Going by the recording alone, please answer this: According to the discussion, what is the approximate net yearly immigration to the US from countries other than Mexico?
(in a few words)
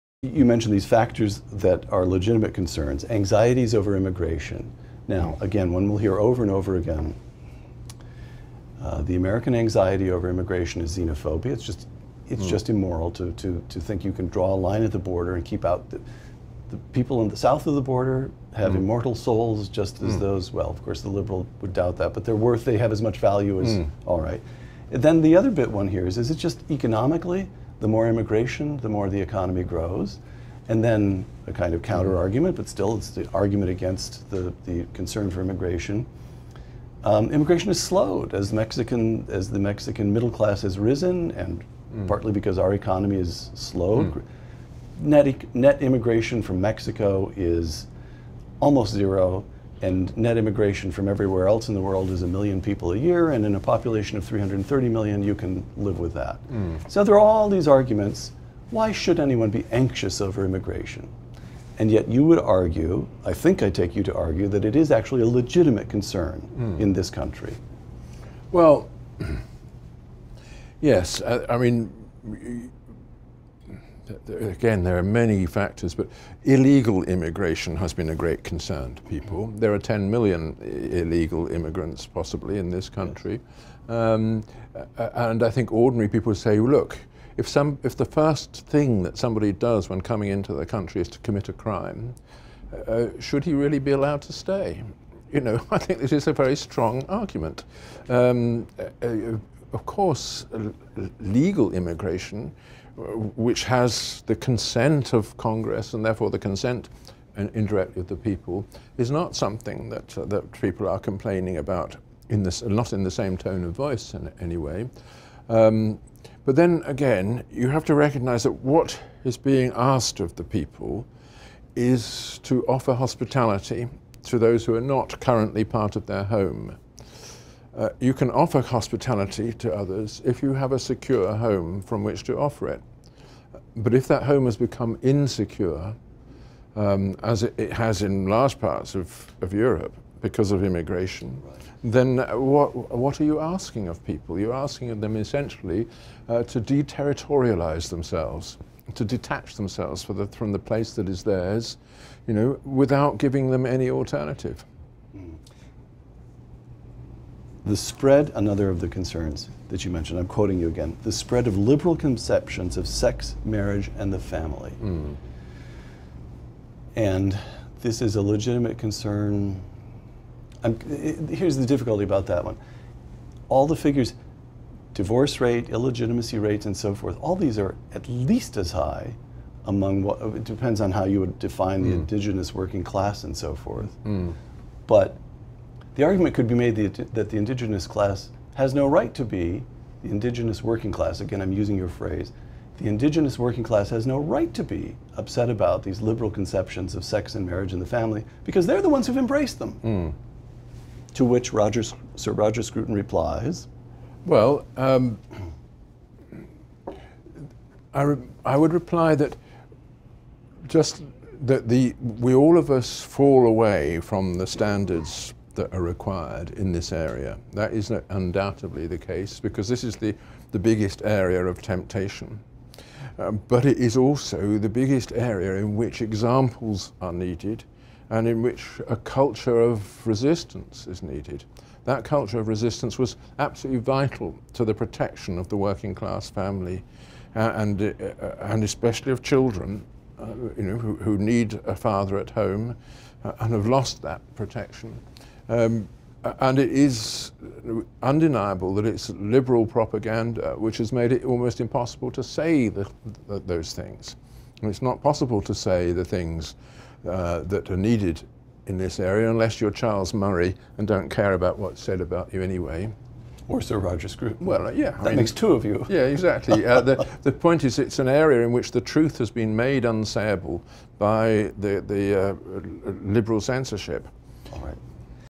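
1 million people.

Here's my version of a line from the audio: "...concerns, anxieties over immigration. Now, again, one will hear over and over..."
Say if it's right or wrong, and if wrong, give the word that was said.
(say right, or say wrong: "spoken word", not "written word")
right.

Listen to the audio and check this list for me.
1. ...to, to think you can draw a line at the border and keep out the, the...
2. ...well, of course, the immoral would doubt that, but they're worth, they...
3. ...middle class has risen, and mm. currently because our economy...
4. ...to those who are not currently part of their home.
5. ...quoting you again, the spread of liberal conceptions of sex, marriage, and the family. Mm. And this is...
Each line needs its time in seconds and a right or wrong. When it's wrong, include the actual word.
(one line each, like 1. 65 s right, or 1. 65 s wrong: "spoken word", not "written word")
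1. 13 s right
2. 20 s wrong: "liberal", not "immoral"
3. 40 s wrong: "partly", not "currently"
4. 124 s right
5. 160 s right.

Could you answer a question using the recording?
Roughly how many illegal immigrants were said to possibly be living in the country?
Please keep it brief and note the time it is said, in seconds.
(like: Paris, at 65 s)
10 million, at 79 s.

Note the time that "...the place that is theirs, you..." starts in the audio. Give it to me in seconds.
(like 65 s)
150 s.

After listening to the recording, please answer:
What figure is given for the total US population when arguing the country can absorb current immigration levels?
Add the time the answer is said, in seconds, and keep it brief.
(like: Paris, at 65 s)
330 million, at 54 s.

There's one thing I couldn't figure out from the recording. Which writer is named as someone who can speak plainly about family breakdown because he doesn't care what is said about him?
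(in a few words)
Charles Murray.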